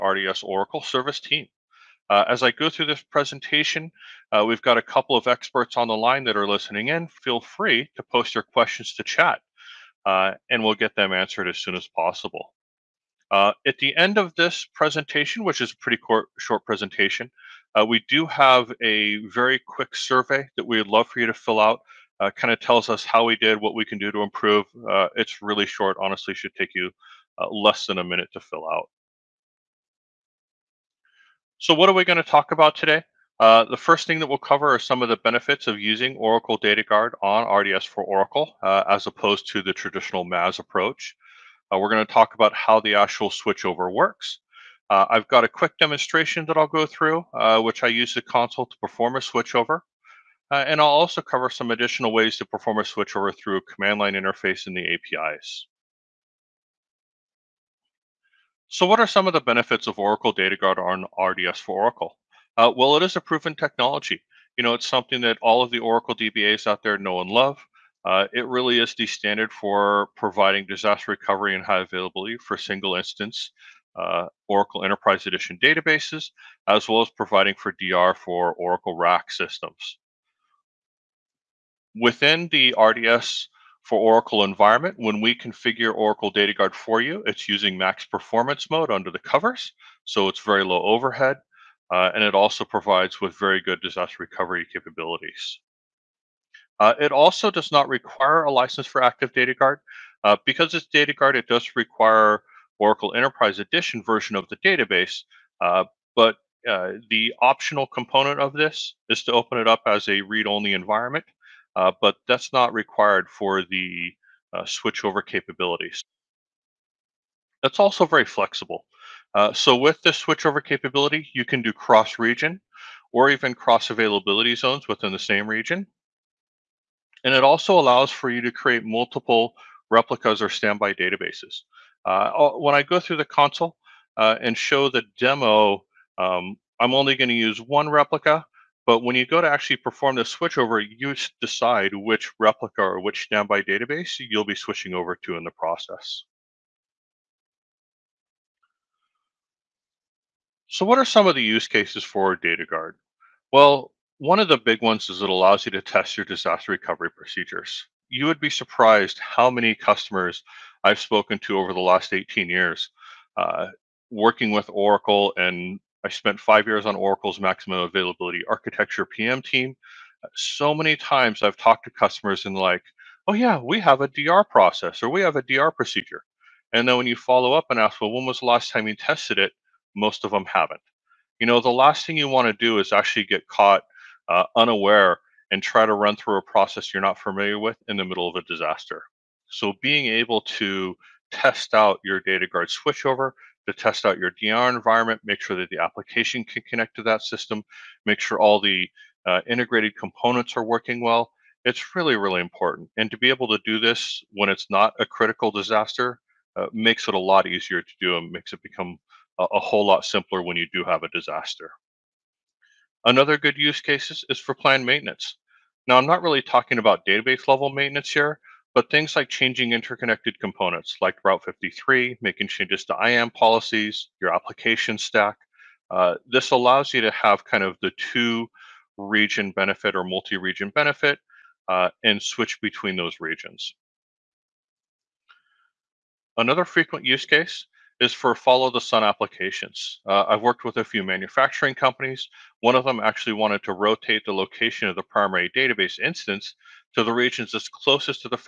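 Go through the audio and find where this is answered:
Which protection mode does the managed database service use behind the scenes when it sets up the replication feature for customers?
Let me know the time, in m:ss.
1:27.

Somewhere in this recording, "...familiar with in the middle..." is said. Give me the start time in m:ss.
3:07.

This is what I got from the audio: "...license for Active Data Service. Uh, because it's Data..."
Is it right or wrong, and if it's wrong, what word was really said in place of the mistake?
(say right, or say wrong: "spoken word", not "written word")
wrong: "Guard", not "Service".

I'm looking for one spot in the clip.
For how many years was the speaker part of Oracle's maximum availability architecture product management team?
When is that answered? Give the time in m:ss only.
2:46.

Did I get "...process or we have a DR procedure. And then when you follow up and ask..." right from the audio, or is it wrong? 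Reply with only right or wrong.
right.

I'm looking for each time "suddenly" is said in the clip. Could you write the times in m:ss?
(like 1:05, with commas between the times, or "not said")
not said.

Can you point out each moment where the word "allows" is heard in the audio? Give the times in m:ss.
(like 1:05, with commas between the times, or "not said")
2:07, 2:35, 3:46.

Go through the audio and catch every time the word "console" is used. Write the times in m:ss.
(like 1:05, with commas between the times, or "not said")
0:48, 2:13.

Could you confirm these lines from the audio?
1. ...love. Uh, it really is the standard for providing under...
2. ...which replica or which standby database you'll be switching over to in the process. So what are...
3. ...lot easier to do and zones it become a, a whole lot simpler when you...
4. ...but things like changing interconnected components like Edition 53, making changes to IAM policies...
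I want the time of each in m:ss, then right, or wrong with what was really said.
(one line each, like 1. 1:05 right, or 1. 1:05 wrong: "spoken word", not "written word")
1. 1:07 wrong: "disaster", not "under"
2. 2:21 right
3. 3:27 wrong: "makes", not "zones"
4. 3:38 wrong: "Route", not "Edition".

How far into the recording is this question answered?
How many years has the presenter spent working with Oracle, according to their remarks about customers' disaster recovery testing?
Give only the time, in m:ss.
2:42.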